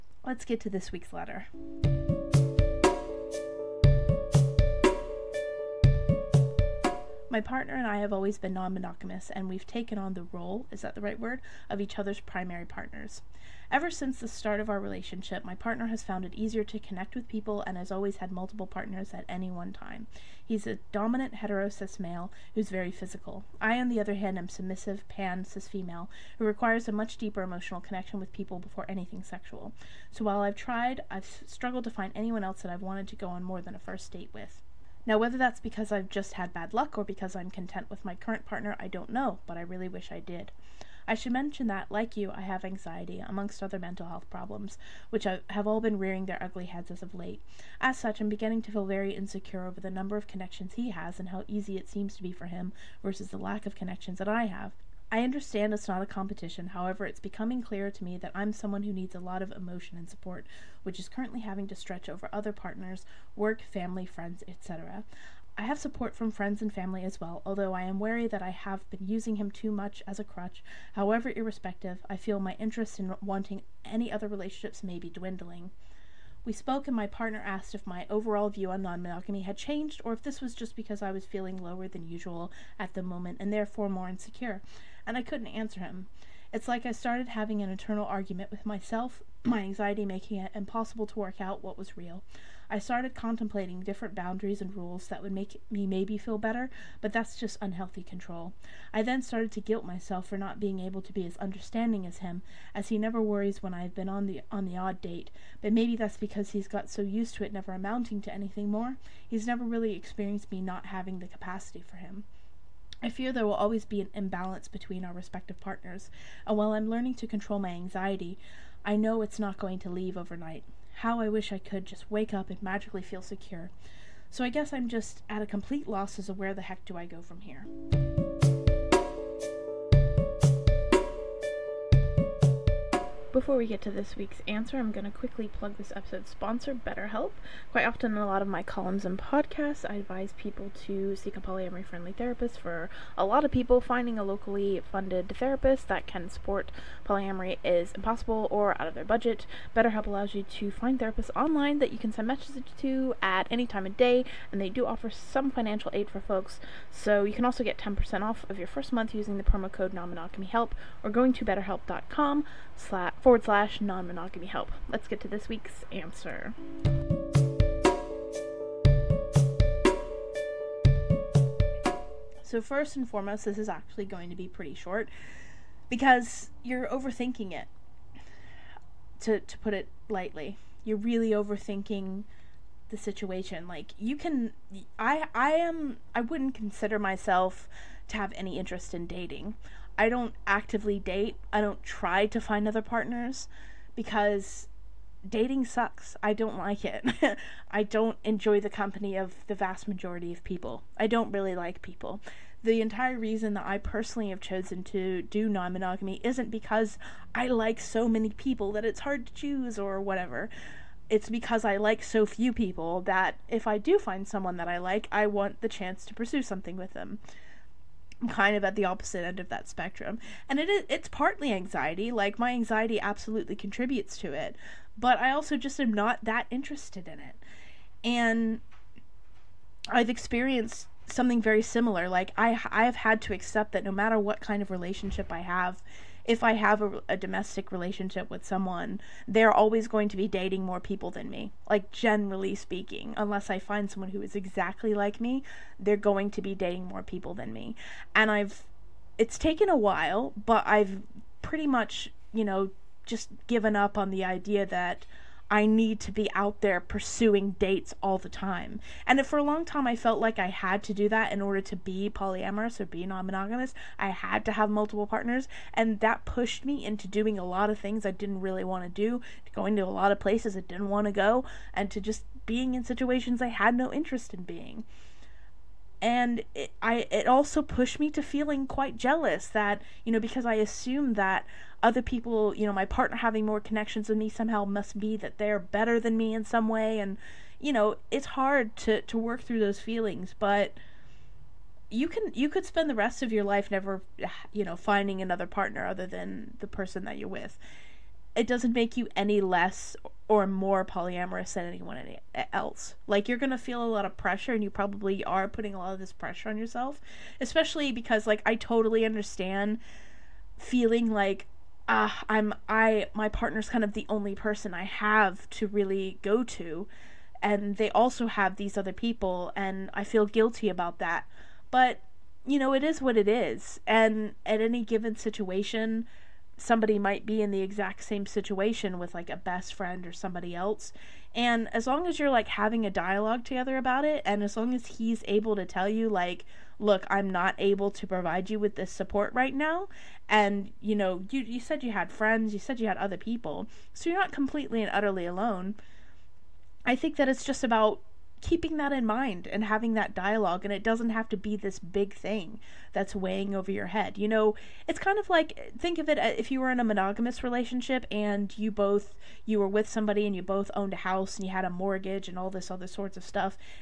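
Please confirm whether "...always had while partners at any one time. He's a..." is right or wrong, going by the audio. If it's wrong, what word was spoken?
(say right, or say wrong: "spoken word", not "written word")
wrong: "multiple", not "while".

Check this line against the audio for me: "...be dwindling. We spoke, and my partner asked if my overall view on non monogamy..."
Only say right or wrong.
right.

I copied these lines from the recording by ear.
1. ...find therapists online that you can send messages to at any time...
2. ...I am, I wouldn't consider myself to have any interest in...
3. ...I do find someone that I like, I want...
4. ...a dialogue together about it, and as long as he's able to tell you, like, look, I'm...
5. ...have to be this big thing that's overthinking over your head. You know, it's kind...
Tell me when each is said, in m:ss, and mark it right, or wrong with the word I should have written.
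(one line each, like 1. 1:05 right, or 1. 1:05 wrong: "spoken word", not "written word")
1. 2:30 right
2. 3:05 right
3. 3:33 right
4. 5:32 right
5. 5:51 wrong: "weighing", not "overthinking".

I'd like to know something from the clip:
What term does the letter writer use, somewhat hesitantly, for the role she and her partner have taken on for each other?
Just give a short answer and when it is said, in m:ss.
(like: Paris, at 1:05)
primary partners, at 0:12.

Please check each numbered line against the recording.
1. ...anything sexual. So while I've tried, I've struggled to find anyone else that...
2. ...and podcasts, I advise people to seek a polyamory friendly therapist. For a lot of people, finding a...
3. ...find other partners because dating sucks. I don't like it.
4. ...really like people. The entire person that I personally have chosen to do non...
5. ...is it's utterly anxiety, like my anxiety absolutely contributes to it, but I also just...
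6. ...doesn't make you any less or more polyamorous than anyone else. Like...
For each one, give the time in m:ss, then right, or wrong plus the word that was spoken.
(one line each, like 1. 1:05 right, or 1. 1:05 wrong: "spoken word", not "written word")
1. 0:28 right
2. 2:19 right
3. 3:12 right
4. 3:21 wrong: "reason", not "person"
5. 3:40 wrong: "partly", not "utterly"
6. 4:58 right.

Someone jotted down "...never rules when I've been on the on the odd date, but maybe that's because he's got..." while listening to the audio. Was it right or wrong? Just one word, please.
wrong.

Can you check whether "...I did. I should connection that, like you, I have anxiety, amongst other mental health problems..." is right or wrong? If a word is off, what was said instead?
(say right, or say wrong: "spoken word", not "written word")
wrong: "mention", not "connection".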